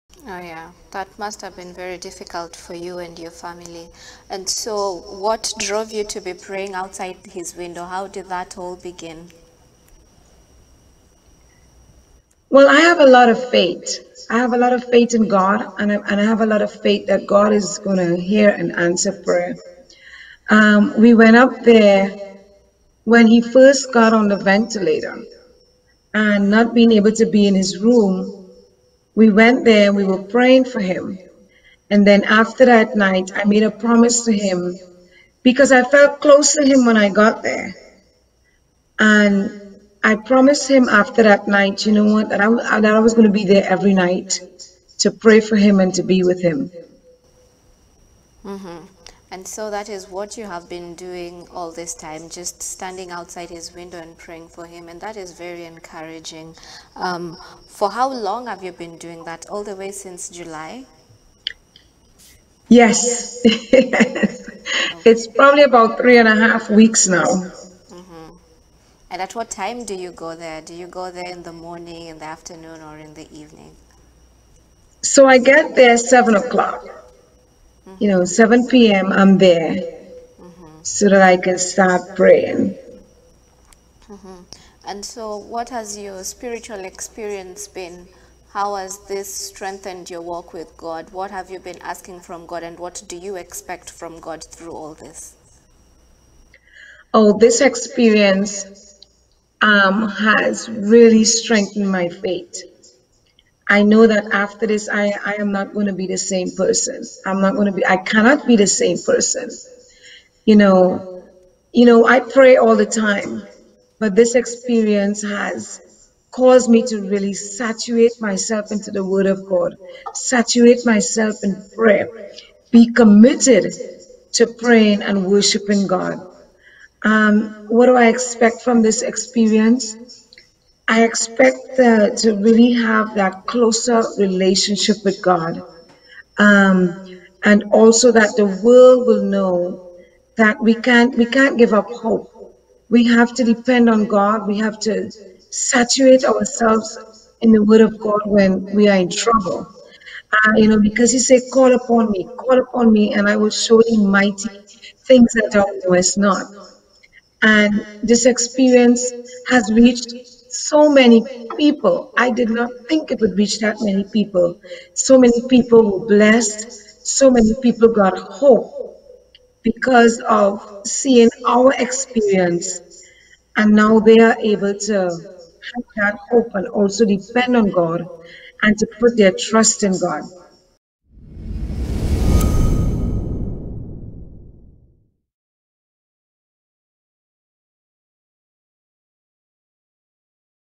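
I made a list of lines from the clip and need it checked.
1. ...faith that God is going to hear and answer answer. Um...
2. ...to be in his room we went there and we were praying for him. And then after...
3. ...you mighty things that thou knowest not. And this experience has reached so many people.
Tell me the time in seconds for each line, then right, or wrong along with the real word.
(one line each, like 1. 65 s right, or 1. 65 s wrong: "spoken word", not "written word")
1. 16 s wrong: "prayer", not "answer"
2. 27 s right
3. 153 s right.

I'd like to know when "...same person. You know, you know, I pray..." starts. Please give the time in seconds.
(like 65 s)
108 s.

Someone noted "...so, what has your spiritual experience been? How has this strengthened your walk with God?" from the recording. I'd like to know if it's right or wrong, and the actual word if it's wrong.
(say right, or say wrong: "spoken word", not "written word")
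right.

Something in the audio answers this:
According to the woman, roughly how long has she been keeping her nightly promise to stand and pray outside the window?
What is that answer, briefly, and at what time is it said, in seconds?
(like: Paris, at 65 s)
3 and a half weeks, at 65 s.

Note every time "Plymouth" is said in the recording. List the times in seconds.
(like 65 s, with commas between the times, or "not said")
not said.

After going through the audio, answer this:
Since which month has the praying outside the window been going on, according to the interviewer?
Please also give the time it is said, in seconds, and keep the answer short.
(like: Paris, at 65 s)
July, at 60 s.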